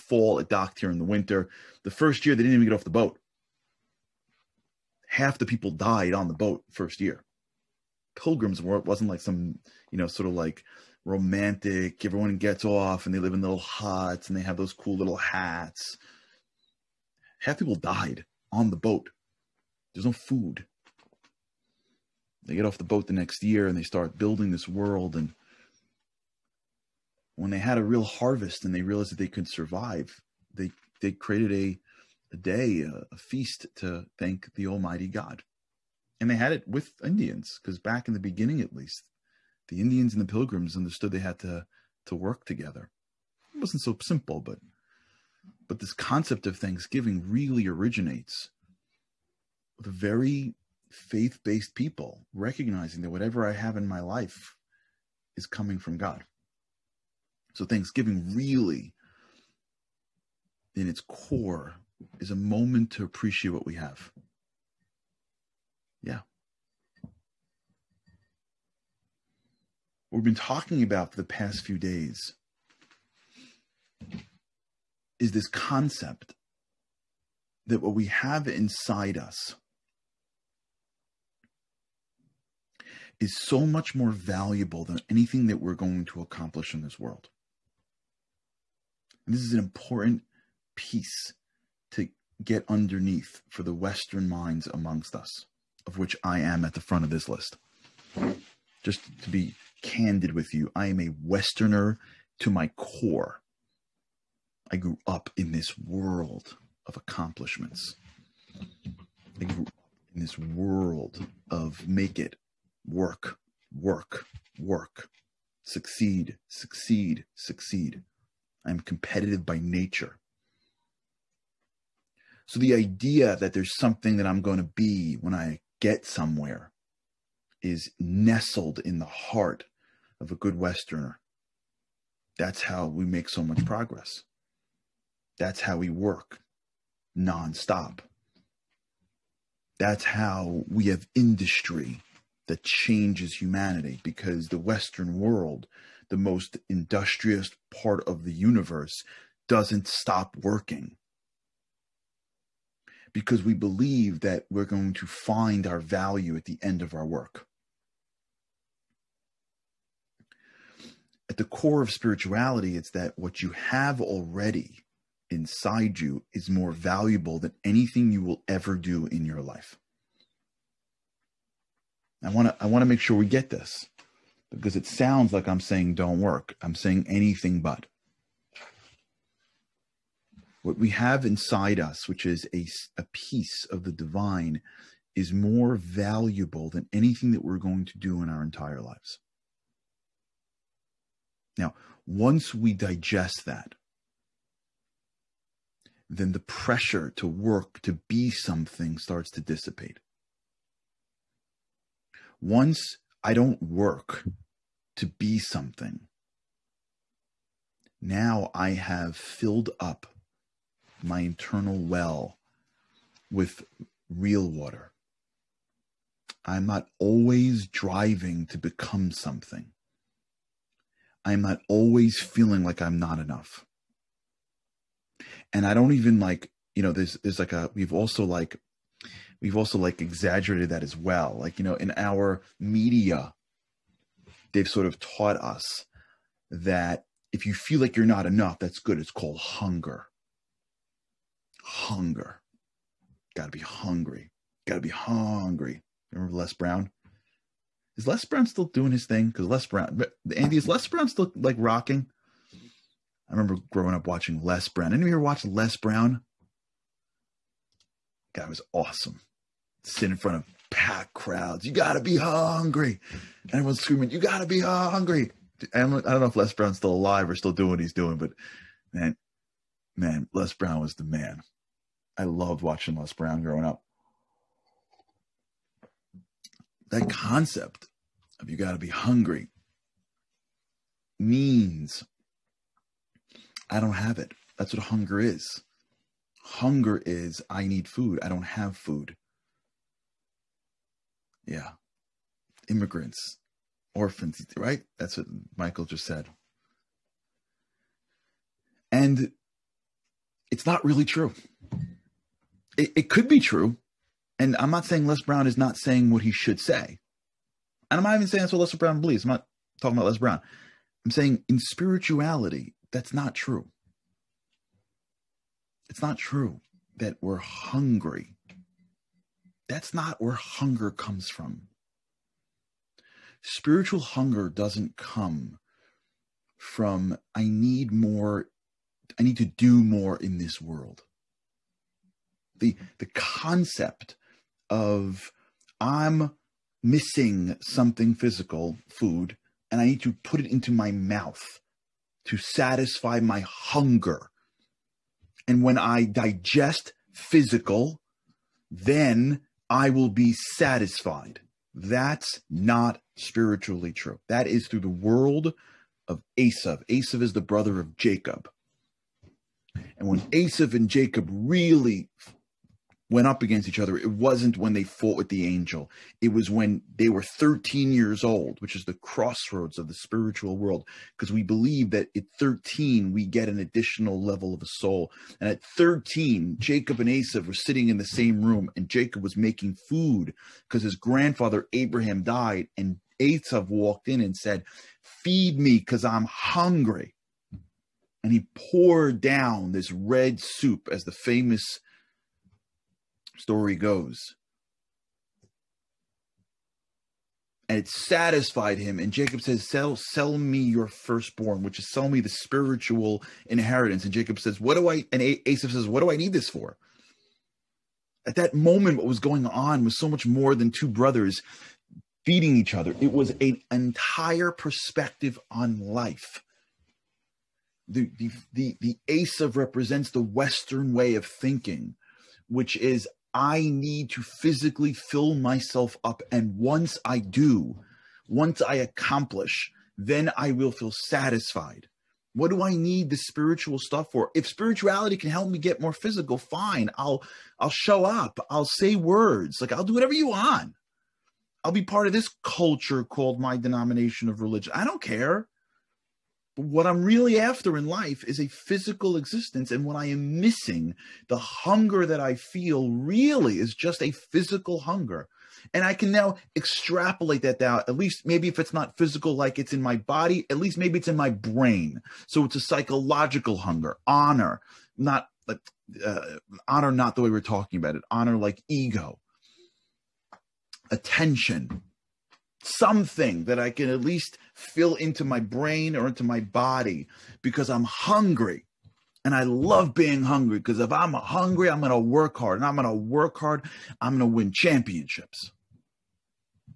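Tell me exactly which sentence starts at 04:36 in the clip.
That concept of you got to be hungry means I don't have it.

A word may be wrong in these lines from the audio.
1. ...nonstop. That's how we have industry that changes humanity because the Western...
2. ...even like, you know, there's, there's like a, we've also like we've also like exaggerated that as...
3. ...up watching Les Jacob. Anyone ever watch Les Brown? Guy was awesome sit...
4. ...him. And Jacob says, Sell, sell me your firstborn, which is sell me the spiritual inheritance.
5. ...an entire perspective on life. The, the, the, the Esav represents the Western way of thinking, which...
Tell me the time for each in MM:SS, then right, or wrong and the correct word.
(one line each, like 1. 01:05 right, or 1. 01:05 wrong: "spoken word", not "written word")
1. 02:17 right
2. 03:45 right
3. 04:13 wrong: "Brown", not "Jacob"
4. 06:38 right
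5. 06:53 right.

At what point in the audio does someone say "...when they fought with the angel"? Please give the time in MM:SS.
06:04.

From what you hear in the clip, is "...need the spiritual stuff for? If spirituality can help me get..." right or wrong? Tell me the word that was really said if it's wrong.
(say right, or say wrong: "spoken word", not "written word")
right.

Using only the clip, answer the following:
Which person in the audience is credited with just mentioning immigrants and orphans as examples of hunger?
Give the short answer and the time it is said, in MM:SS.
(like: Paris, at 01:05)
Michael, at 04:55.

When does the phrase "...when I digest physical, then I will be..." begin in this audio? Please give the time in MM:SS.
05:45.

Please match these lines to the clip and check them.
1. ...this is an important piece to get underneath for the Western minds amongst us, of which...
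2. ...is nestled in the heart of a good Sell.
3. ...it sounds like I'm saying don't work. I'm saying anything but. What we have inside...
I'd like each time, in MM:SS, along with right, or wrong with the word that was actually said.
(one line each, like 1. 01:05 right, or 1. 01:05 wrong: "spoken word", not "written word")
1. 01:29 right
2. 02:07 wrong: "Westerner", not "Sell"
3. 02:54 right.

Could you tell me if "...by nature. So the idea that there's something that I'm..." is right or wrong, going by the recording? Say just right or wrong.
right.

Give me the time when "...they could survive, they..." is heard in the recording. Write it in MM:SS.
00:29.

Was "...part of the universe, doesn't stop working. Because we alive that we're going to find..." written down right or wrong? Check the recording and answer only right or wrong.
wrong.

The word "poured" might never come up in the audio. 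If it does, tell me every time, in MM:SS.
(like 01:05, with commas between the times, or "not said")
06:28.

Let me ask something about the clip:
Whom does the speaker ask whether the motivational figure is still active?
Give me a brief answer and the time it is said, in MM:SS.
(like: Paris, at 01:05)
Andy, at 04:10.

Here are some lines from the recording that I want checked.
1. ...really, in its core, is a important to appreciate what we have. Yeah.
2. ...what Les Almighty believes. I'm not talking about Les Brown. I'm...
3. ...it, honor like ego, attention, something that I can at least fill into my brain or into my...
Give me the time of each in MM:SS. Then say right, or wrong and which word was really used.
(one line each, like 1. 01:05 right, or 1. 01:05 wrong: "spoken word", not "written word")
1. 00:58 wrong: "moment", not "important"
2. 05:08 wrong: "Brown", not "Almighty"
3. 07:47 right.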